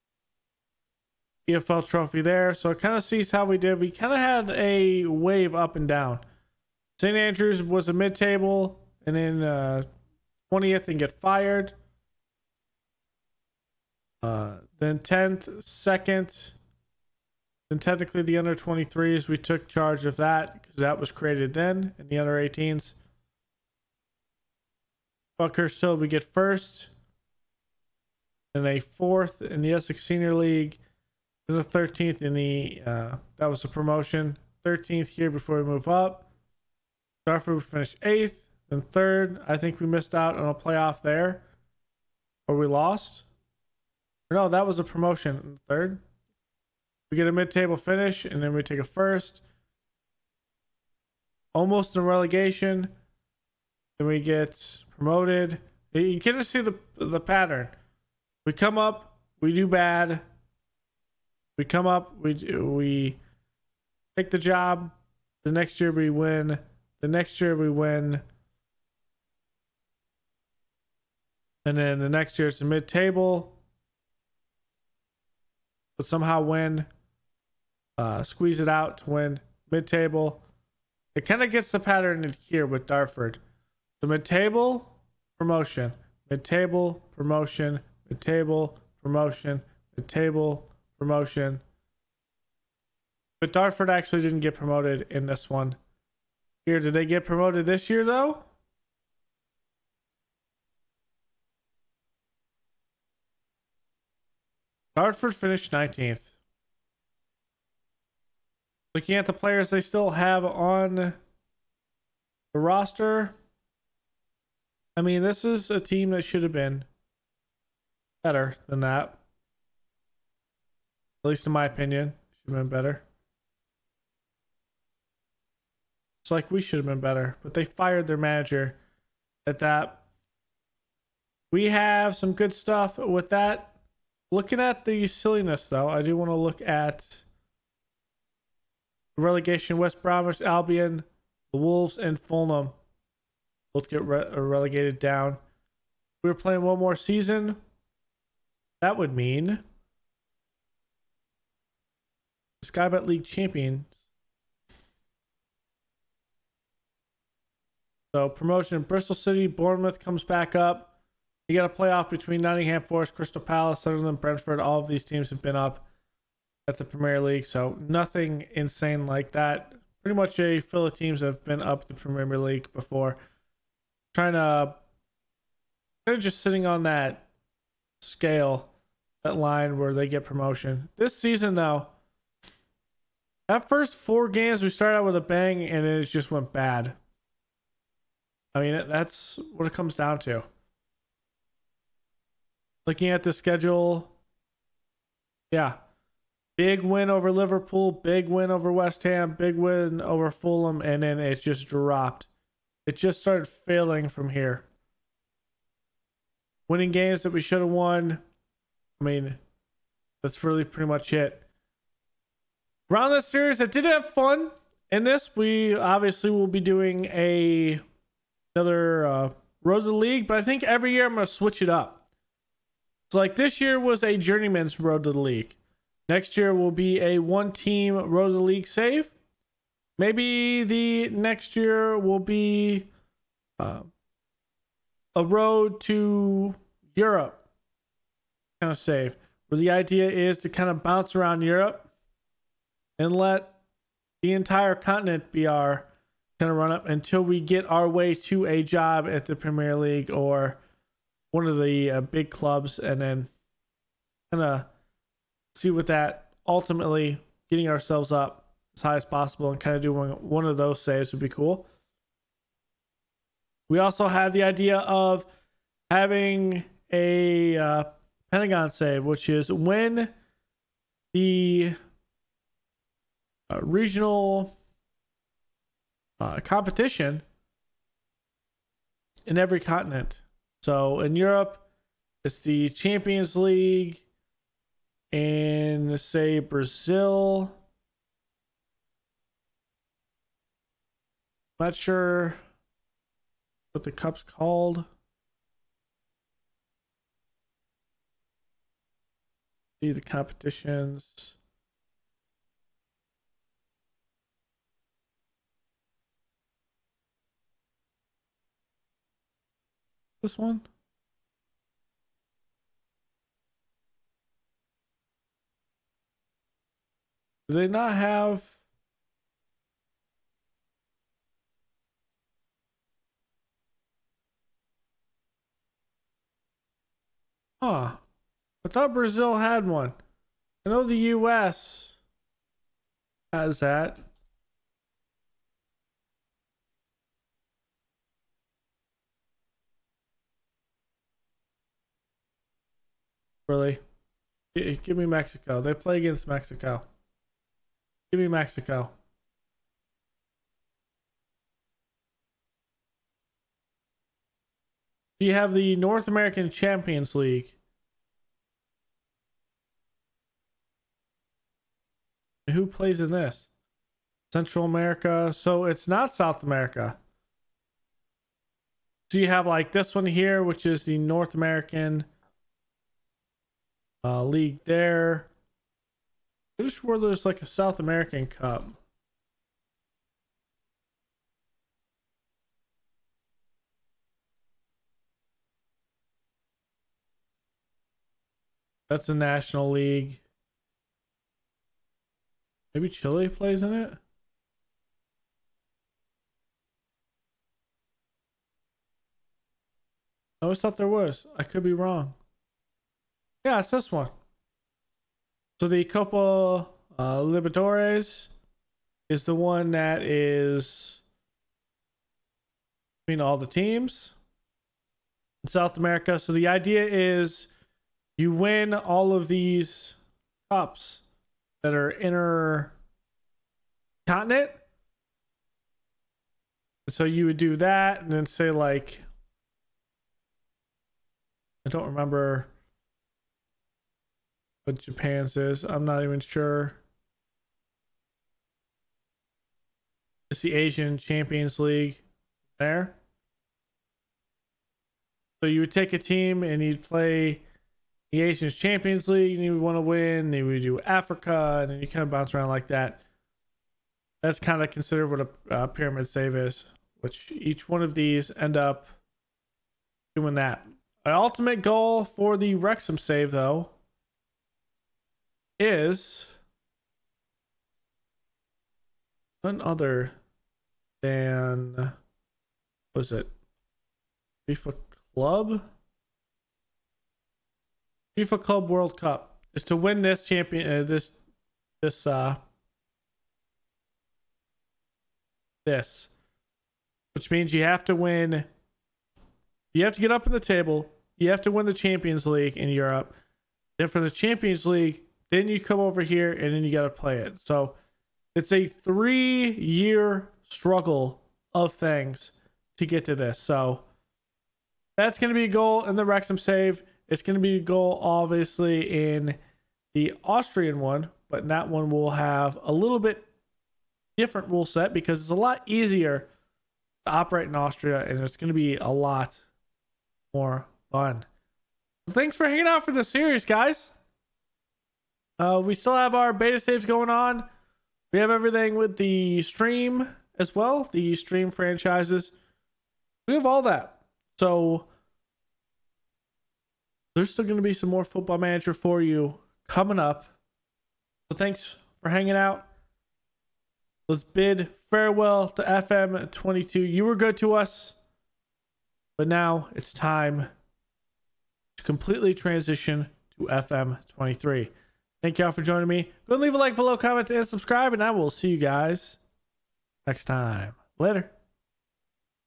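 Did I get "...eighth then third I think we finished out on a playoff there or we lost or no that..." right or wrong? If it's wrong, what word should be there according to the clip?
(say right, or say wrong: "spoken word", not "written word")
wrong: "missed", not "finished".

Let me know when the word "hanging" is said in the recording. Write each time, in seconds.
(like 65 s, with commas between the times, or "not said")
522 s, 542 s.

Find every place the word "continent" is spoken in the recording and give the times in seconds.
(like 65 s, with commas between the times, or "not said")
244 s, 279 s, 424 s.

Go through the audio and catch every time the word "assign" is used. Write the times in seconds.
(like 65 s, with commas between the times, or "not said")
not said.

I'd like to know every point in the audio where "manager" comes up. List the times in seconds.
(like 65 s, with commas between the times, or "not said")
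128 s, 538 s.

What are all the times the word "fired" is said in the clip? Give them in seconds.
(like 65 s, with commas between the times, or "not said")
11 s, 127 s.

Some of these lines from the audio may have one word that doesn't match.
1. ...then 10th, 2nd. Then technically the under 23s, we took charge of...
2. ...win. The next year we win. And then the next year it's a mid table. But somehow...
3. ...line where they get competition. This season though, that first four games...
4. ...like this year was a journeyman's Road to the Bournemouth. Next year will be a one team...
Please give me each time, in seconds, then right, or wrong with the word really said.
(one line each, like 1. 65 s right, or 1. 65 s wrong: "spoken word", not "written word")
1. 14 s right
2. 66 s right
3. 179 s wrong: "promotion", not "competition"
4. 223 s wrong: "League", not "Bournemouth".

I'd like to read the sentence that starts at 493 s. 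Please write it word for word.
Then for the Champions League, then you come over here and then you got to play it.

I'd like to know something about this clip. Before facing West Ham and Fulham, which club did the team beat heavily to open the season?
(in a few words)
Liverpool.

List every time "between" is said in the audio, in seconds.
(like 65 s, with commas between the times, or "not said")
162 s, 413 s.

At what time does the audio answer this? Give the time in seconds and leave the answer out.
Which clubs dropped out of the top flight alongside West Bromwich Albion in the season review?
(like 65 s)
141 s.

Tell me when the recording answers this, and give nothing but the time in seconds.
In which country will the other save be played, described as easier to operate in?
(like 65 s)
517 s.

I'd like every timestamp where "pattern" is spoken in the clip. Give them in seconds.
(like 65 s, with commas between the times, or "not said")
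57 s, 81 s.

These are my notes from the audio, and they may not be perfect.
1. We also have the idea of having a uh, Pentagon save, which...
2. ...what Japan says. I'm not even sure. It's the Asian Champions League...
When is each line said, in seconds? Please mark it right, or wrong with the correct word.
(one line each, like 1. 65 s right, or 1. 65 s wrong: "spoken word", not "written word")
1. 263 s right
2. 434 s right.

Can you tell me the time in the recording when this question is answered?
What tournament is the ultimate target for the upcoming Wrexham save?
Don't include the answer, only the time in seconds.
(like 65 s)
478 s.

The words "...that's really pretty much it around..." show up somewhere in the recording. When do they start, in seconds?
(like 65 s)
210 s.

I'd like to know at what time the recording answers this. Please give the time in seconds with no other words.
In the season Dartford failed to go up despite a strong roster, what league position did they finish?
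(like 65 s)
105 s.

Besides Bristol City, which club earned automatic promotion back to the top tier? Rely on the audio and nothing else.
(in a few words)
Bournemouth.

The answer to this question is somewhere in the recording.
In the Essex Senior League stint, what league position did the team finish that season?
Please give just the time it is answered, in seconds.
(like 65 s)
28 s.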